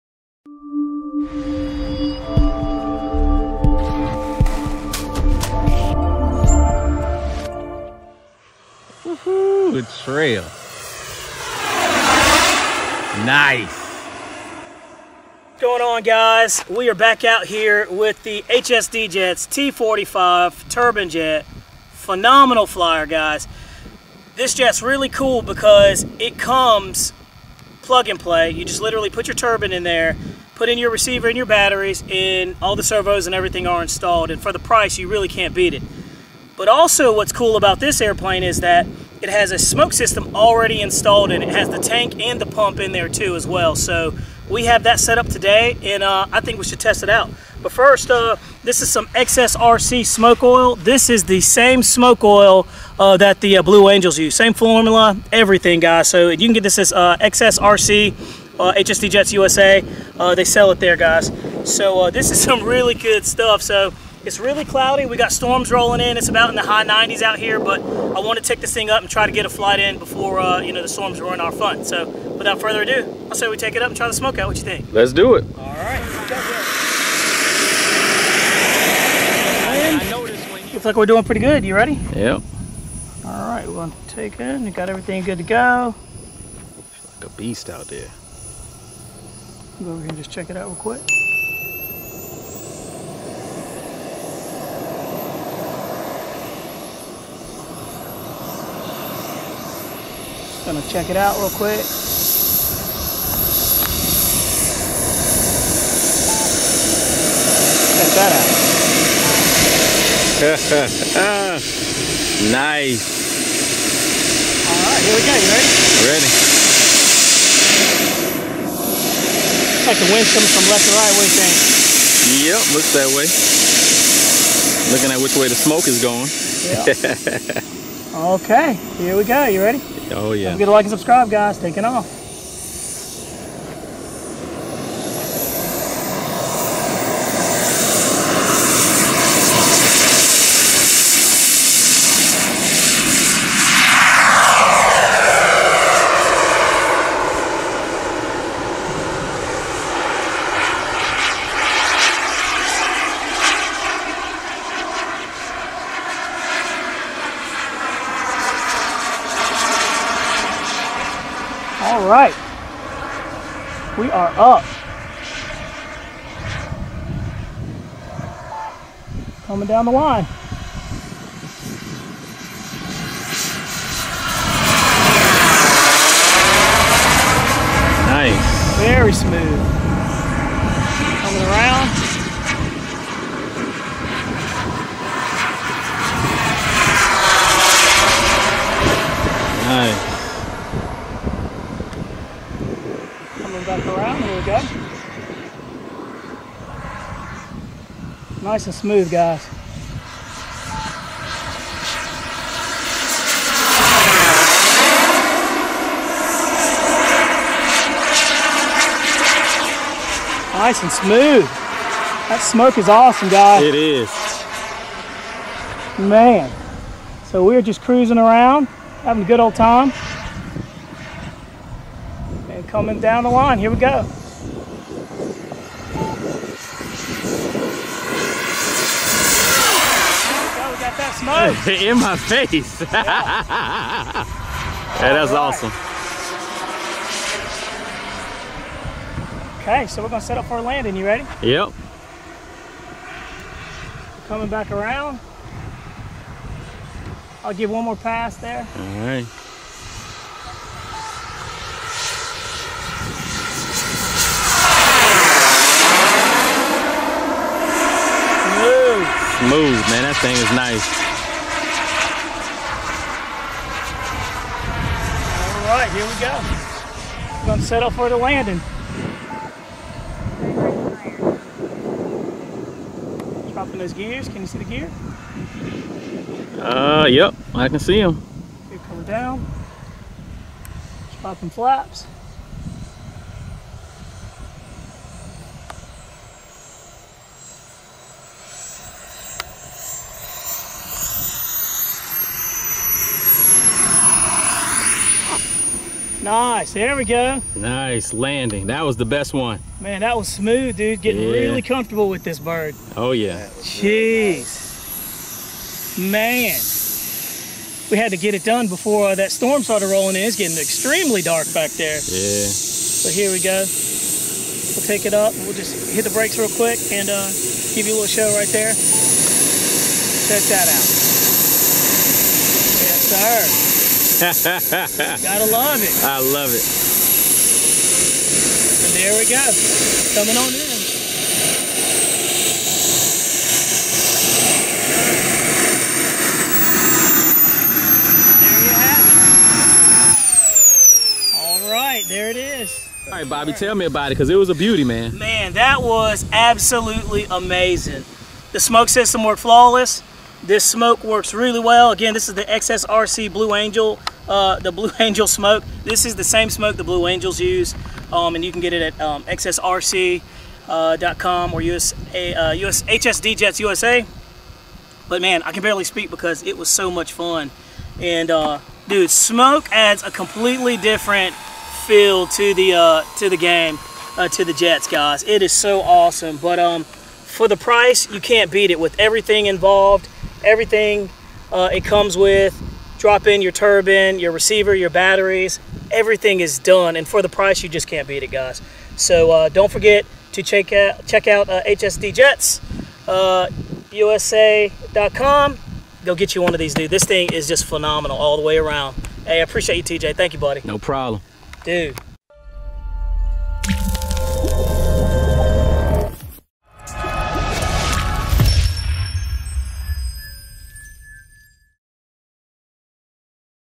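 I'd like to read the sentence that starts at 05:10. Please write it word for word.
It's getting extremely dark back there.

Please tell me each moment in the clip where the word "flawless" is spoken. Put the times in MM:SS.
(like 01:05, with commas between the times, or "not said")
05:49.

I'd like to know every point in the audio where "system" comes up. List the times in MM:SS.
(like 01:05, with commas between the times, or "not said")
00:39, 05:48.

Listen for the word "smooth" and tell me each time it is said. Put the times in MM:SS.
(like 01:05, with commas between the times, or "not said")
02:59, 03:18, 03:30, 04:19, 05:00.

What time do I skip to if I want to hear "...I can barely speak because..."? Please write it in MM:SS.
06:05.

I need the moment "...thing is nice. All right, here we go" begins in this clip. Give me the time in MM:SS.
04:20.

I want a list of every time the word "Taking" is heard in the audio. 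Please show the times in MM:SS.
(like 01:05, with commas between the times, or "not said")
02:11.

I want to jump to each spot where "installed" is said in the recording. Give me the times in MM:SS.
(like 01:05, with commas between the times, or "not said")
00:33, 00:40.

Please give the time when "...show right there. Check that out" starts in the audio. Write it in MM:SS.
05:18.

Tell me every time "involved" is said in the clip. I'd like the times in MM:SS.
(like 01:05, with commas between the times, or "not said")
06:19.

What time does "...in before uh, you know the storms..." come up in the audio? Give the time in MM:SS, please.
01:09.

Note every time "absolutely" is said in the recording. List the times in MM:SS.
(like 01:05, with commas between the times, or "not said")
05:46.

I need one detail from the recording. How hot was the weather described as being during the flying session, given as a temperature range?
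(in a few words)
high 90s.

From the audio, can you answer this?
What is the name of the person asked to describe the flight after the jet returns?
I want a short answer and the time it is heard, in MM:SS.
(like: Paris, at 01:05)
Bobby, at 05:43.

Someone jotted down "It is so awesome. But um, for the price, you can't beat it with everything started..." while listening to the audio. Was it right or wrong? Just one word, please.
wrong.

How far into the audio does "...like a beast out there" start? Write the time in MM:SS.
01:27.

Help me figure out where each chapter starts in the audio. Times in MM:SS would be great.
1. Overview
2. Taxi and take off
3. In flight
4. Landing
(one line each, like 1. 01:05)
1. 00:31
2. 01:20
3. 03:58
4. 04:44.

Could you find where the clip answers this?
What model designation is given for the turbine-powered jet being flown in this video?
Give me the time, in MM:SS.
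00:19.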